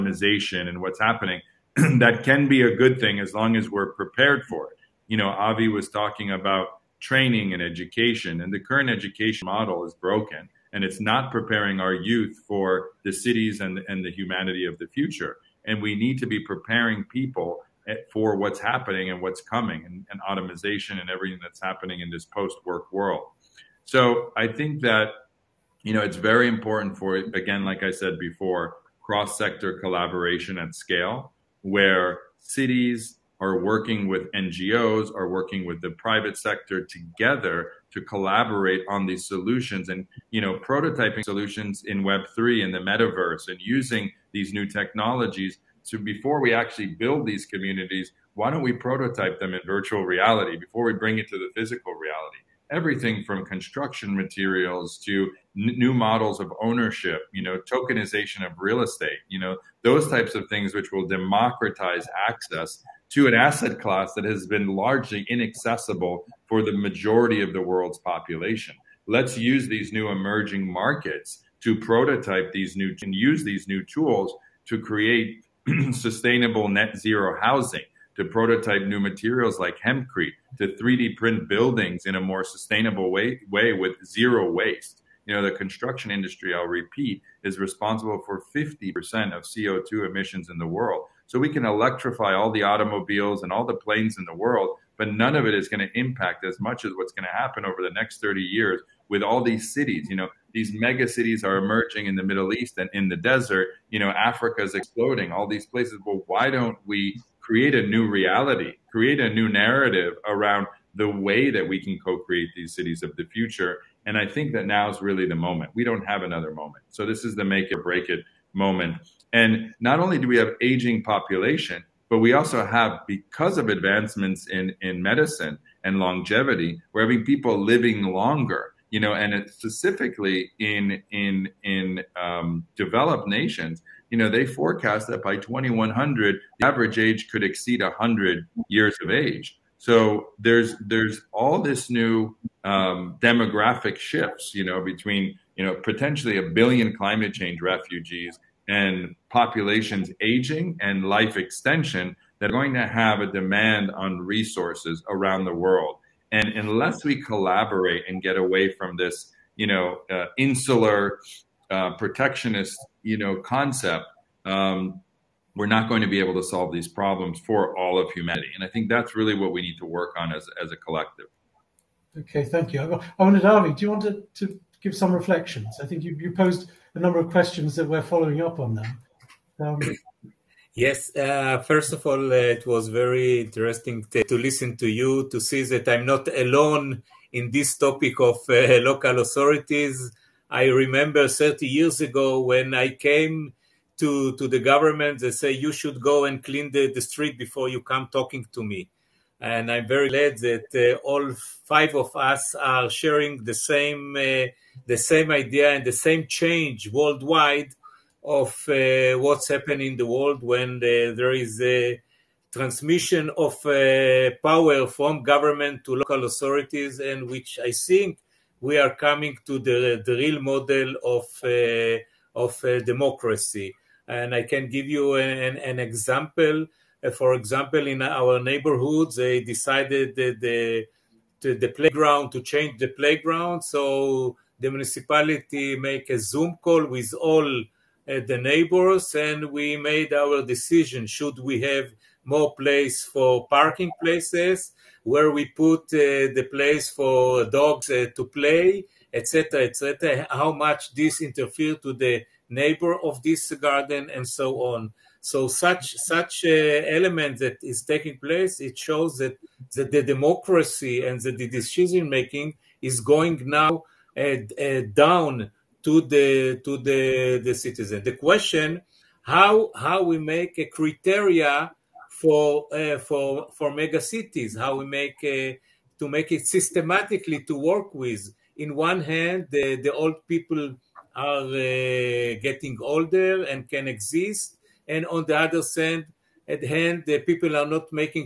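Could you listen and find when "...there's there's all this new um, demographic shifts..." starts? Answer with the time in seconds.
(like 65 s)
140 s.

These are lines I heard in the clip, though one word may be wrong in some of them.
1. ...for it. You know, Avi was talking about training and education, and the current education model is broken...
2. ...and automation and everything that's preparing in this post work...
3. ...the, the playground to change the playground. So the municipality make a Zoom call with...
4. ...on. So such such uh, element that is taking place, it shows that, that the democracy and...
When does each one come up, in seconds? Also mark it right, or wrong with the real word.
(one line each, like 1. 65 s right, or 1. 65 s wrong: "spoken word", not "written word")
1. 4 s right
2. 20 s wrong: "happening", not "preparing"
3. 231 s right
4. 254 s right.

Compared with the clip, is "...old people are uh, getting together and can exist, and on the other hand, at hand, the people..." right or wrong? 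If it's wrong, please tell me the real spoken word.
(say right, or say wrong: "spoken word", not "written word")
wrong: "older", not "together".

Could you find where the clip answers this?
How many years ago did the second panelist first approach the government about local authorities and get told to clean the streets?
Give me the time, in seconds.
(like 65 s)
191 s.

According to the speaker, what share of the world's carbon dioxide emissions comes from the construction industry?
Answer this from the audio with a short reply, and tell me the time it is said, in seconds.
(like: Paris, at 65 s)
50%, at 88 s.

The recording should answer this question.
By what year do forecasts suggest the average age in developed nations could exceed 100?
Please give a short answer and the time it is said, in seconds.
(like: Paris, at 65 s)
2100, at 135 s.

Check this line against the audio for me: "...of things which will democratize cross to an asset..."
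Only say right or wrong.
wrong.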